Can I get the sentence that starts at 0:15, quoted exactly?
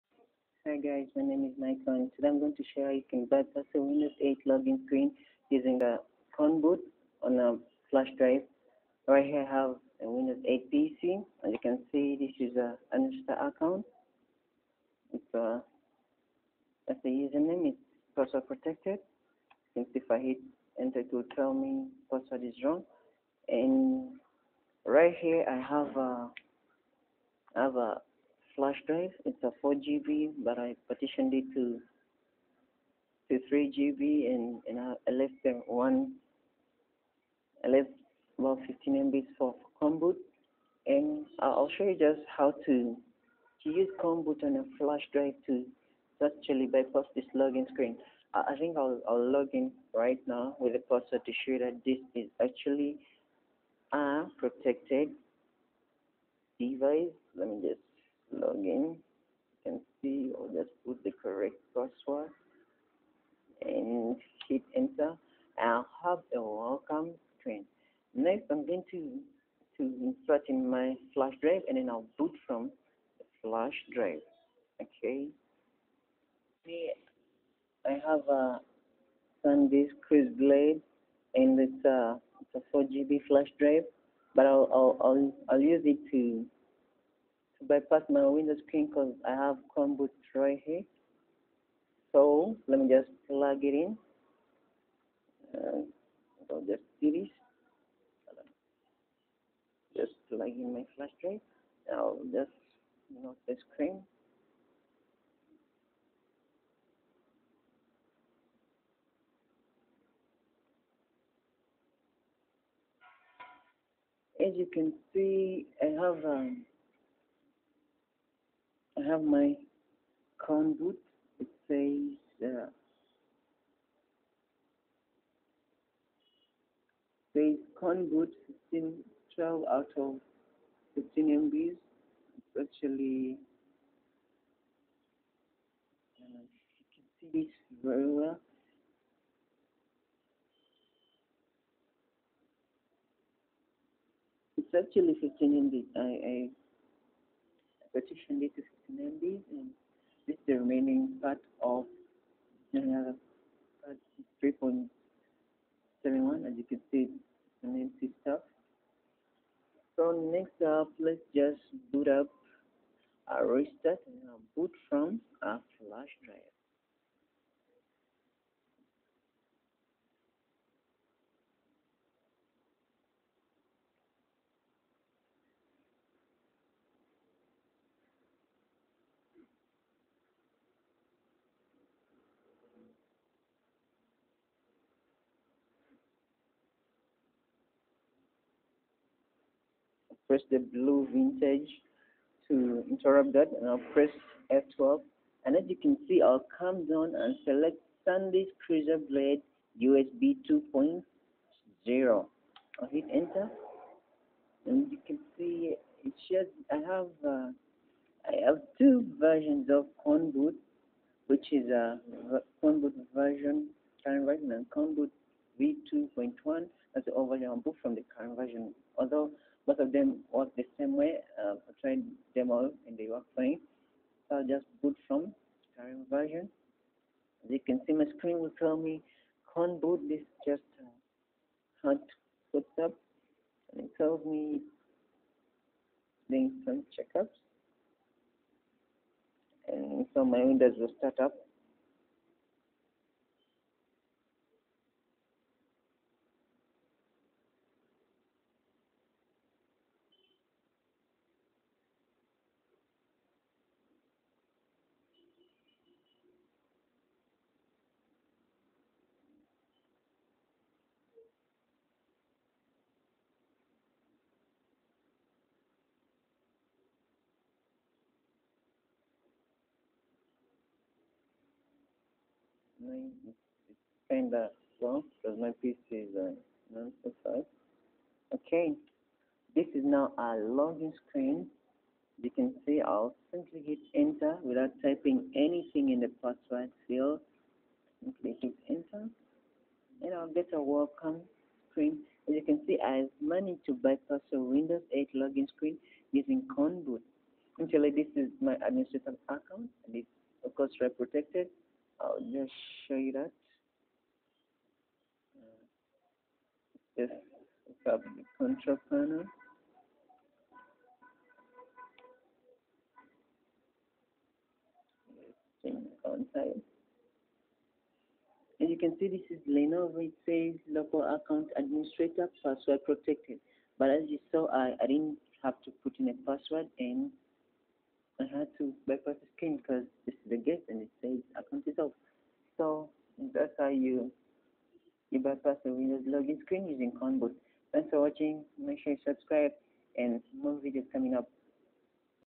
It's a, uh, that's the username, it's password protected.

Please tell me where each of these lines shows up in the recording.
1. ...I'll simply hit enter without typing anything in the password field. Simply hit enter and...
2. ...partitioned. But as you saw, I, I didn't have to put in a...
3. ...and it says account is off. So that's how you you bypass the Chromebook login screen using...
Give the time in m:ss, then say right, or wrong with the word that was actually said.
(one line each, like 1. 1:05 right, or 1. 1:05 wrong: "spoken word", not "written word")
1. 4:42 right
2. 5:22 wrong: "protected", not "partitioned"
3. 5:30 wrong: "Windows", not "Chromebook".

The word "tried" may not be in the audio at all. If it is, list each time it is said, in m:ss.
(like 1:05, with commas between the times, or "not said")
3:41.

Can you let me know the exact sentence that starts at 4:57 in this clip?
Actually, this is my administrative account and it's of course right protected.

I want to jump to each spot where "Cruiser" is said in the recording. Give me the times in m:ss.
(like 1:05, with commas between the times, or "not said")
3:18.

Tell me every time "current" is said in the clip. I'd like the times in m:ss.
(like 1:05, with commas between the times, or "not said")
3:34, 3:38, 3:45.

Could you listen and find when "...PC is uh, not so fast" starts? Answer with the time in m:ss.
4:35.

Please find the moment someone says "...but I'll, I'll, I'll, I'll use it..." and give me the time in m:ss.
1:24.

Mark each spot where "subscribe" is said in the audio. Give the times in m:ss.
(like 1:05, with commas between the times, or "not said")
5:39.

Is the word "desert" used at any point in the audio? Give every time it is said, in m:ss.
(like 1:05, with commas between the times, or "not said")
not said.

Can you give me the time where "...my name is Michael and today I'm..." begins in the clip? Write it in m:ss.
0:01.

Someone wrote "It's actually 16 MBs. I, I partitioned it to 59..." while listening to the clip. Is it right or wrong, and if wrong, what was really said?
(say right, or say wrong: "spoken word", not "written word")
wrong: "15", not "16".